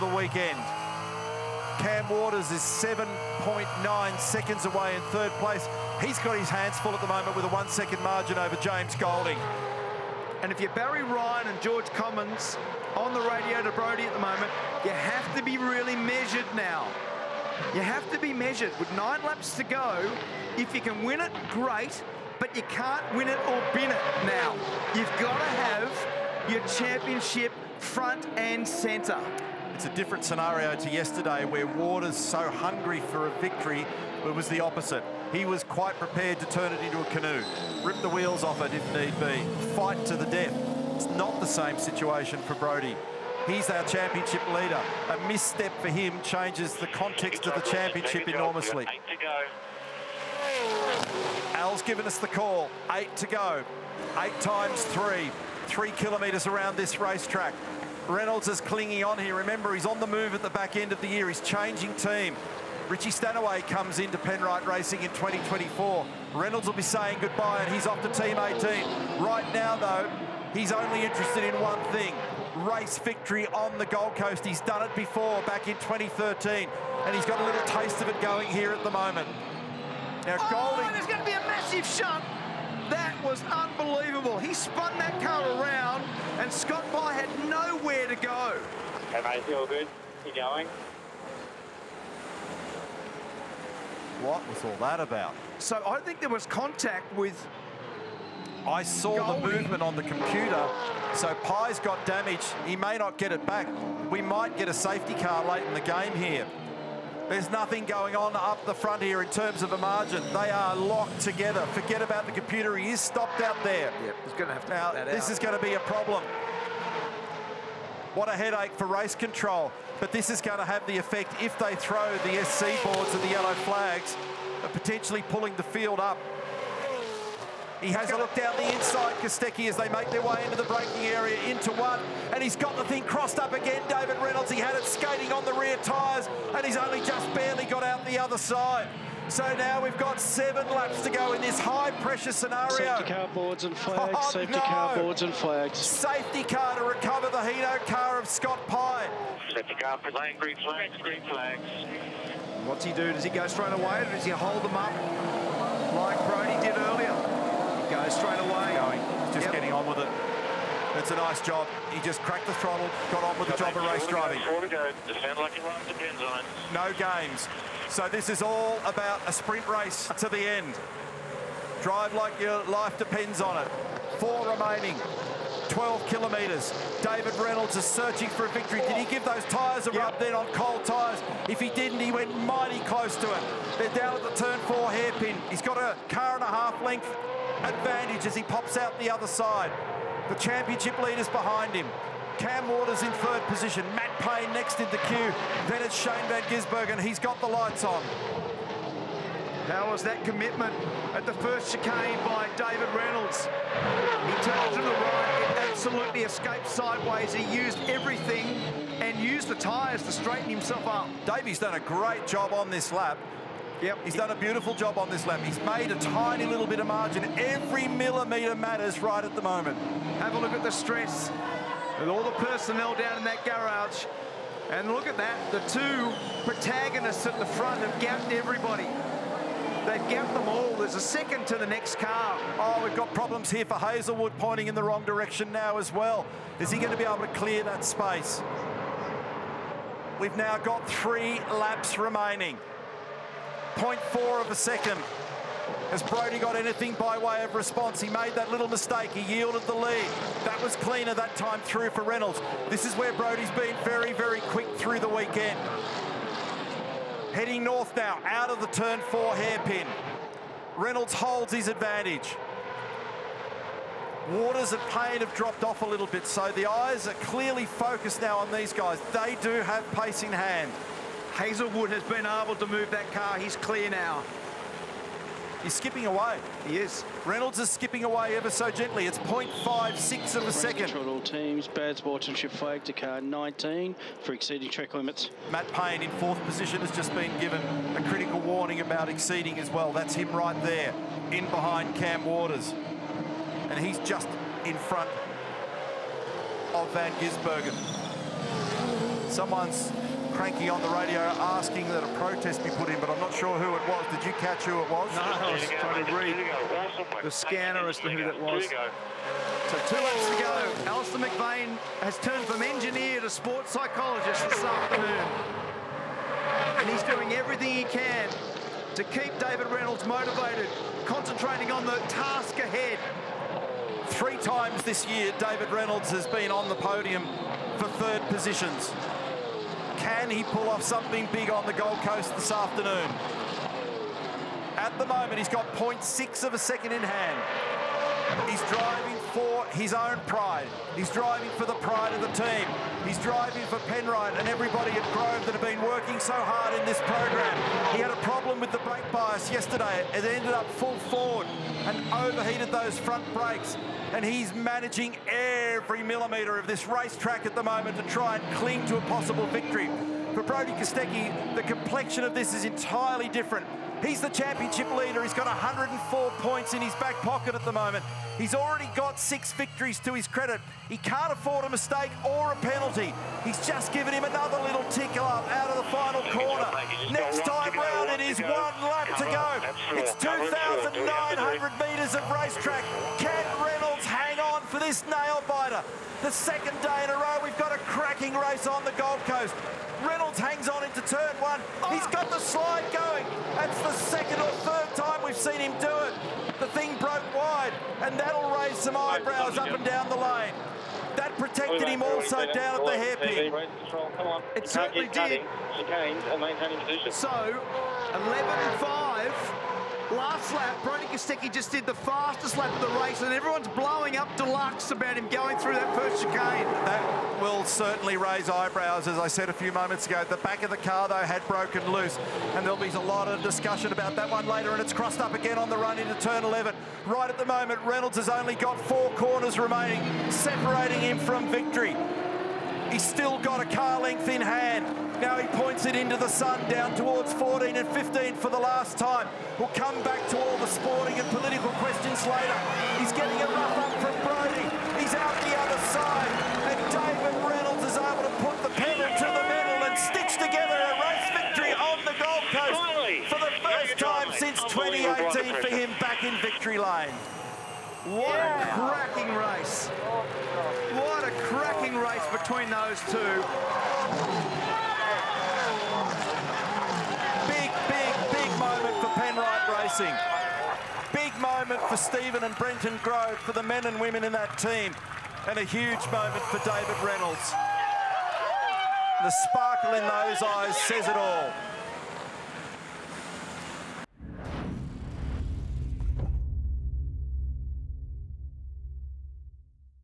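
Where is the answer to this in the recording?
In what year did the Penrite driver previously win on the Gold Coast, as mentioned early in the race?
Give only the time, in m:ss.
1:15.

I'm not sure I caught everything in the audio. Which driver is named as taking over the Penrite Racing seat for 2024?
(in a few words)
Richie Stanaway.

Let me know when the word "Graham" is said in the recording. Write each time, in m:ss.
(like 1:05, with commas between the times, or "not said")
not said.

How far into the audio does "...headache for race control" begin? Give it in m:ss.
1:58.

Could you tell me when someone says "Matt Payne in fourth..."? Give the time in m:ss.
4:45.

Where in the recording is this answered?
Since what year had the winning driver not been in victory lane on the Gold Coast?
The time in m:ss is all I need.
7:34.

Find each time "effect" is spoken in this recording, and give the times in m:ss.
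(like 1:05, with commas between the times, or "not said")
2:00.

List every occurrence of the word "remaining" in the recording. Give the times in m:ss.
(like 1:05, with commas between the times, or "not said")
2:54, 4:01, 7:09.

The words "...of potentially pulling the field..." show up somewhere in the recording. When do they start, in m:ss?
2:04.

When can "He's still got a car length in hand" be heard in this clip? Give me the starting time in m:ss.
7:12.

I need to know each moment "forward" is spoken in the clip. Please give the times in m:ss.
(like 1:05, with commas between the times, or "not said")
5:51.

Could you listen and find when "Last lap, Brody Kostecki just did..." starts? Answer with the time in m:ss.
6:50.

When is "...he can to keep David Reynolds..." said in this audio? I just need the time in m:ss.
5:17.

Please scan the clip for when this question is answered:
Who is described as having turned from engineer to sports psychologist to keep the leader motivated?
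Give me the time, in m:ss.
5:10.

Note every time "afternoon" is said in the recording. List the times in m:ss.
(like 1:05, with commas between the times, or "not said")
5:14, 5:32.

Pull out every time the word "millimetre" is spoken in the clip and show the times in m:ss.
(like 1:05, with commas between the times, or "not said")
3:37, 5:56.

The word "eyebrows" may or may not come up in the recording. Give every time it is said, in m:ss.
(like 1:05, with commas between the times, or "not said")
6:38, 6:58.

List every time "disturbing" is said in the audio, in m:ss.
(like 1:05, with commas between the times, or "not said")
not said.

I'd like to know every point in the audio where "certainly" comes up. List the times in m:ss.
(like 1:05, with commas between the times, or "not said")
6:44, 6:57.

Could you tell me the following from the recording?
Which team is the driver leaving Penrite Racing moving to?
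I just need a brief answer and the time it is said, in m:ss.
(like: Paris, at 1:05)
Team 18, at 1:08.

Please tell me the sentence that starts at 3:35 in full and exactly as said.
He's made a tiny little bit of margin.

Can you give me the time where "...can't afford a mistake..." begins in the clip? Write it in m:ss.
6:10.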